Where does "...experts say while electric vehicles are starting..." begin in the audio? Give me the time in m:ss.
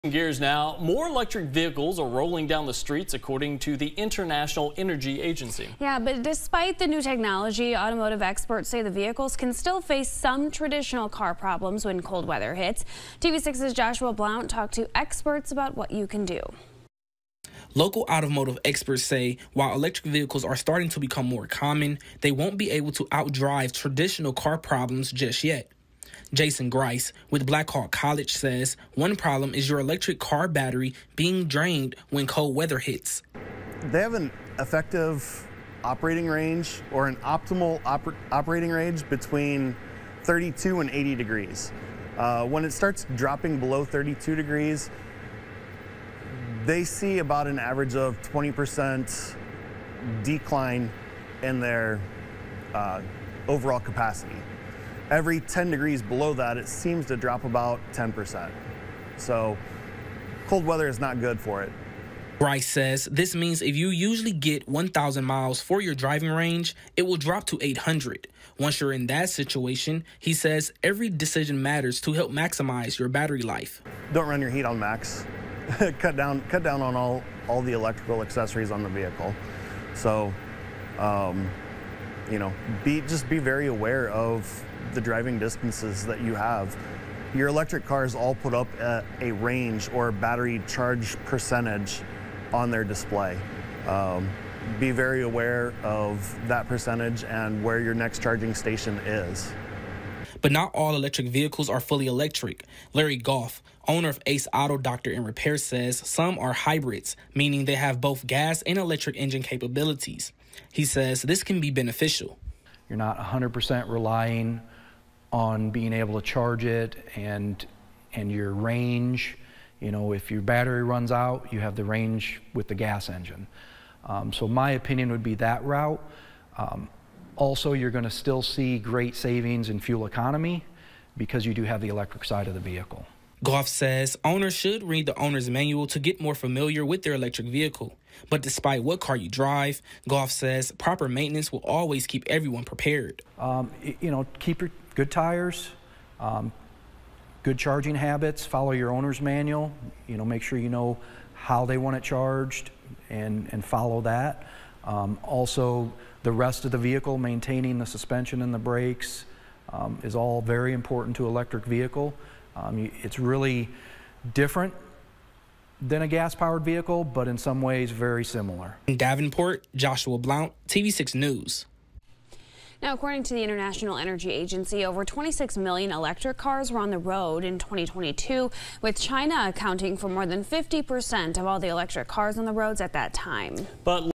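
0:18.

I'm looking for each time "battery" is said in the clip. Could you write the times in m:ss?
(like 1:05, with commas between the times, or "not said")
0:30, 1:13, 1:30, 2:00.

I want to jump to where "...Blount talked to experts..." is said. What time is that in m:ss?
0:14.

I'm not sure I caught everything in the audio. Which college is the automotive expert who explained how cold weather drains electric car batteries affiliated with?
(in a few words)
Blackhawk College.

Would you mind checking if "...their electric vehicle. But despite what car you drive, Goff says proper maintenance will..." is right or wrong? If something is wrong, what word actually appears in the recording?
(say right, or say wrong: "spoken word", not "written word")
right.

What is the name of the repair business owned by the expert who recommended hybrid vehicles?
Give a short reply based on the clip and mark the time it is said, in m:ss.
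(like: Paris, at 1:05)
Ace Auto Doctor and Repair, at 1:44.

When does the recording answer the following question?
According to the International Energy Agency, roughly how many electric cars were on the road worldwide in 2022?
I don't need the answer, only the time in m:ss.
2:54.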